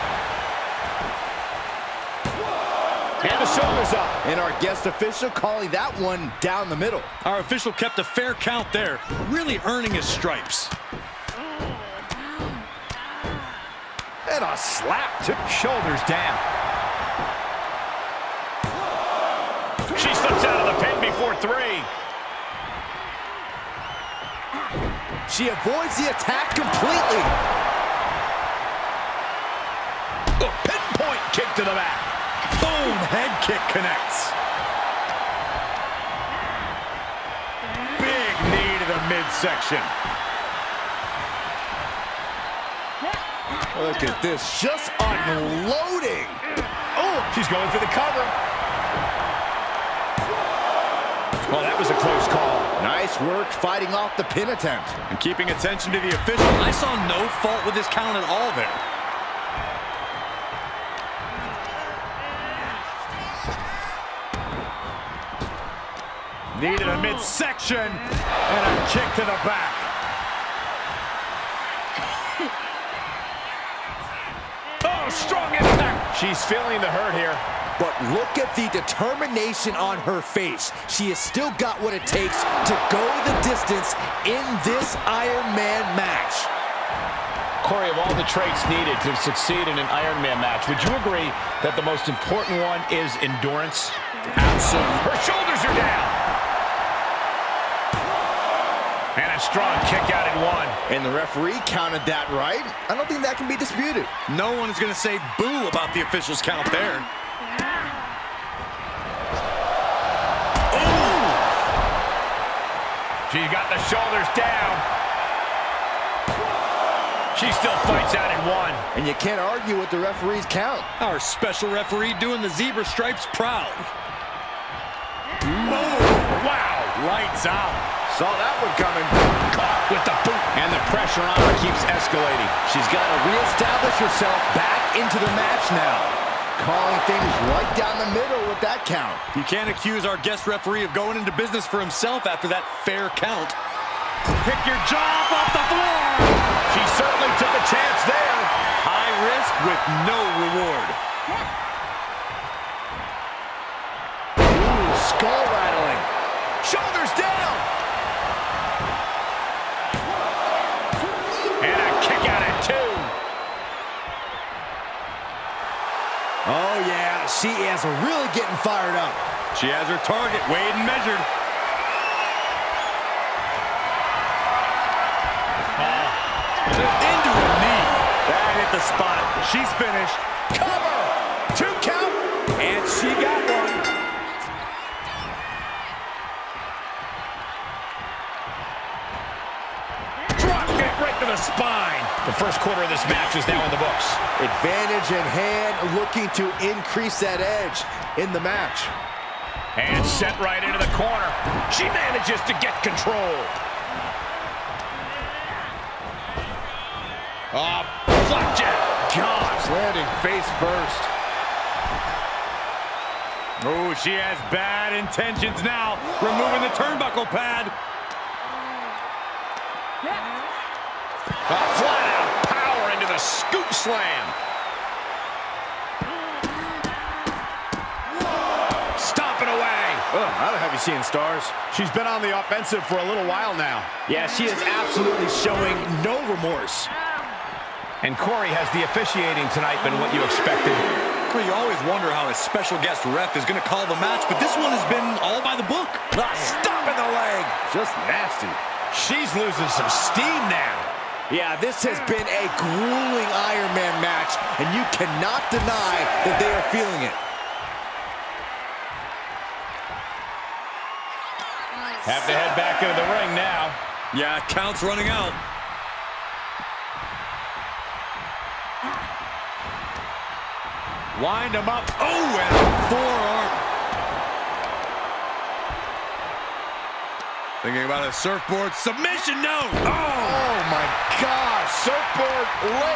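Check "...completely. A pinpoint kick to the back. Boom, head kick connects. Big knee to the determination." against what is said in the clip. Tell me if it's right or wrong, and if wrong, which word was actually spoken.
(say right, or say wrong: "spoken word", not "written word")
wrong: "midsection", not "determination".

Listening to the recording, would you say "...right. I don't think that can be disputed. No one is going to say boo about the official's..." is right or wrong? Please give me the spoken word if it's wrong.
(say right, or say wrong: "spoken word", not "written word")
right.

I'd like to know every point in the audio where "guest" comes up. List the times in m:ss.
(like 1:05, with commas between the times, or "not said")
0:04, 2:20, 4:02.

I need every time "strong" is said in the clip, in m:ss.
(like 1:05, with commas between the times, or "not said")
1:15, 1:39.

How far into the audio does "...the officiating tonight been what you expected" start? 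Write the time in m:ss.
3:58.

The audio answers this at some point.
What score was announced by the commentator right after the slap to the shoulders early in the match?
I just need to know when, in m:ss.
0:21.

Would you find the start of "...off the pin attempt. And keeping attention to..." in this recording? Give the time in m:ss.
0:53.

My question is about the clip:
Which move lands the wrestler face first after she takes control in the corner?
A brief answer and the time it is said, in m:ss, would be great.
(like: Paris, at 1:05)
Flapjack, at 3:28.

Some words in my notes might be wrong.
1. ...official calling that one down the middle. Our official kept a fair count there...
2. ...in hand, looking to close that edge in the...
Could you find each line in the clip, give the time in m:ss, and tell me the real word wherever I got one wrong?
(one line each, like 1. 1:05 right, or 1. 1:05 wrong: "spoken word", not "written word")
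1. 0:04 right
2. 3:15 wrong: "increase", not "close".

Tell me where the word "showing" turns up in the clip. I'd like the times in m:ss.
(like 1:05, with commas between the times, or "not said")
3:55.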